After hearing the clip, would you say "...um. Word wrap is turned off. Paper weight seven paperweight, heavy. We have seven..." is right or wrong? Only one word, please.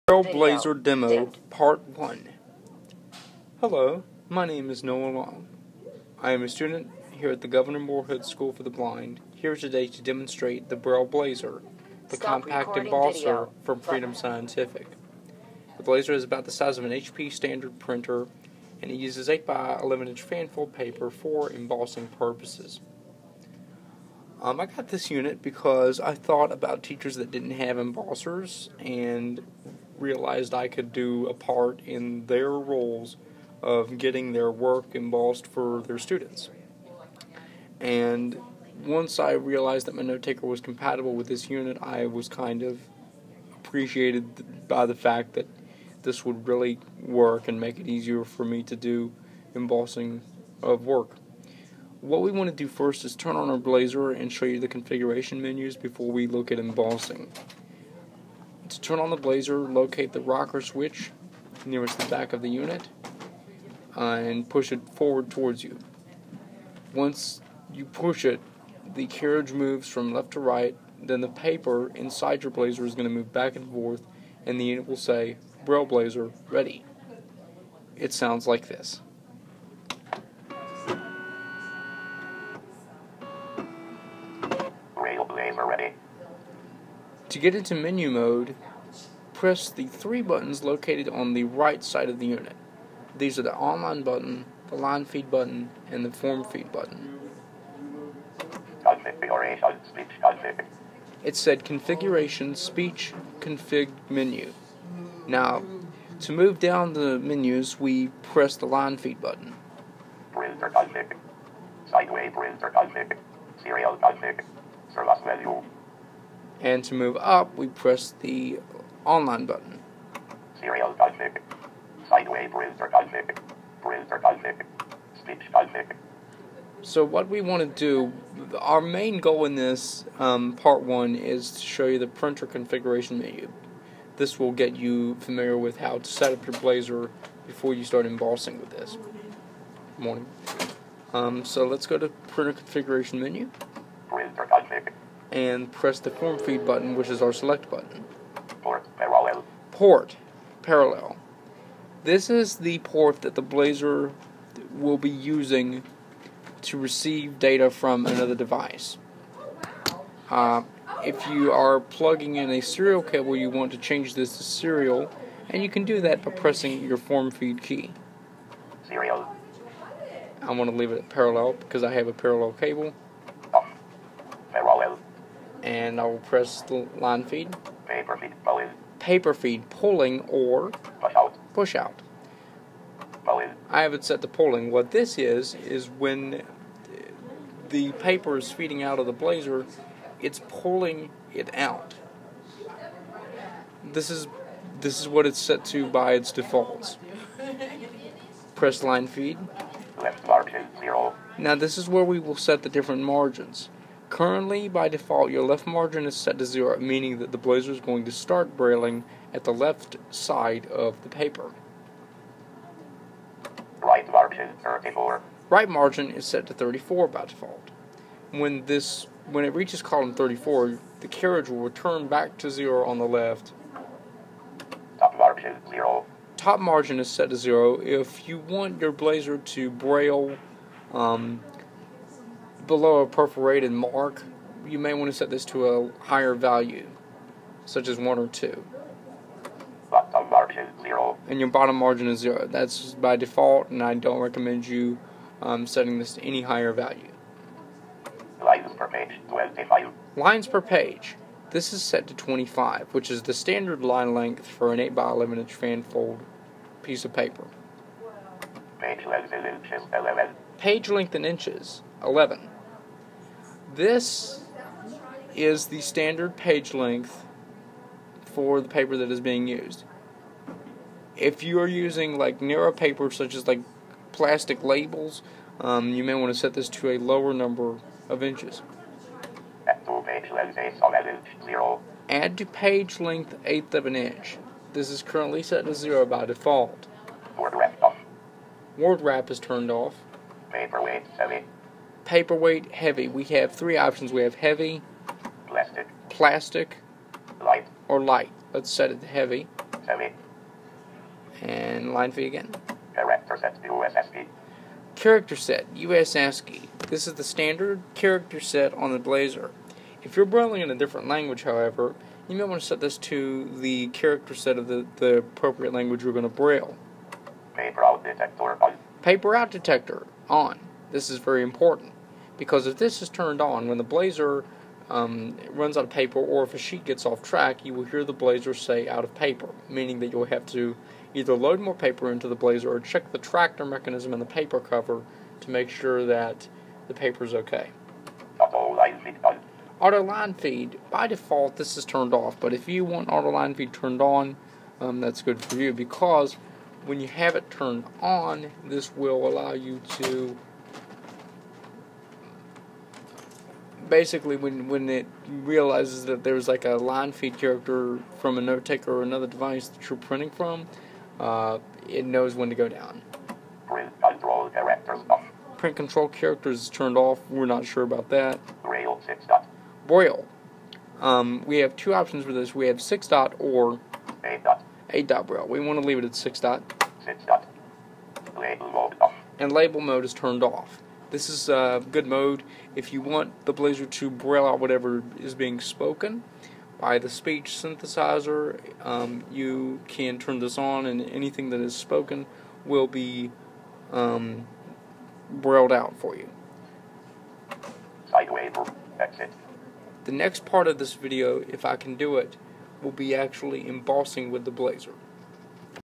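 wrong.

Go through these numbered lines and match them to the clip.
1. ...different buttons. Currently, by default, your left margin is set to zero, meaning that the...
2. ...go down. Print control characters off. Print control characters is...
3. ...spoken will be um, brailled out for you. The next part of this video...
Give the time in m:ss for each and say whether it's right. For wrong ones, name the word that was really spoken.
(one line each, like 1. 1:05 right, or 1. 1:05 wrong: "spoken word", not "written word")
1. 3:22 wrong: "margins", not "buttons"
2. 6:02 right
3. 6:31 right.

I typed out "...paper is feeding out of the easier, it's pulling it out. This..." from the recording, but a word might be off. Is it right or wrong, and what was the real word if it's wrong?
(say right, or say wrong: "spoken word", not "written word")
wrong: "blazer", not "easier".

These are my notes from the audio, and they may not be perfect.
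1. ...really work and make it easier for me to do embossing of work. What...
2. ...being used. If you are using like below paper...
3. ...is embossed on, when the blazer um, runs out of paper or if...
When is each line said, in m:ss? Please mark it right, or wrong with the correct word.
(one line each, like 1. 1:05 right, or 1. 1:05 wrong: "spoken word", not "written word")
1. 0:46 right
2. 4:29 wrong: "narrow", not "below"
3. 5:23 wrong: "turned", not "embossed".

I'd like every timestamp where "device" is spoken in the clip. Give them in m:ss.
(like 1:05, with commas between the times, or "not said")
2:38, 5:59.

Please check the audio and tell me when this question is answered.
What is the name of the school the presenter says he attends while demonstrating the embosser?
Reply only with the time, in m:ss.
0:07.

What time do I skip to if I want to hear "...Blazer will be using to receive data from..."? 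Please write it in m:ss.
2:33.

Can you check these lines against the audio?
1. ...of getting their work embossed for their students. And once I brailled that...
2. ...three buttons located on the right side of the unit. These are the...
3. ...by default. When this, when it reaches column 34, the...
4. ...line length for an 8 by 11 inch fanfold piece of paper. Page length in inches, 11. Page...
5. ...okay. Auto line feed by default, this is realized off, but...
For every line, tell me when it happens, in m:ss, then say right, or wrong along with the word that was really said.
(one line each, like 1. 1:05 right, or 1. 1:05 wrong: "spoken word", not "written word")
1. 0:33 wrong: "realized", not "brailled"
2. 1:29 right
3. 3:37 right
4. 4:13 right
5. 5:37 wrong: "turned", not "realized".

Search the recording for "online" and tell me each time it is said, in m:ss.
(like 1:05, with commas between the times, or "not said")
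1:33, 1:59.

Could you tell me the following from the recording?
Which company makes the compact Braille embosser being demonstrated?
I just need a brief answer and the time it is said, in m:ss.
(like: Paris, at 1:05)
Freedom Scientific, at 0:13.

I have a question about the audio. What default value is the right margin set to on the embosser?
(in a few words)
34.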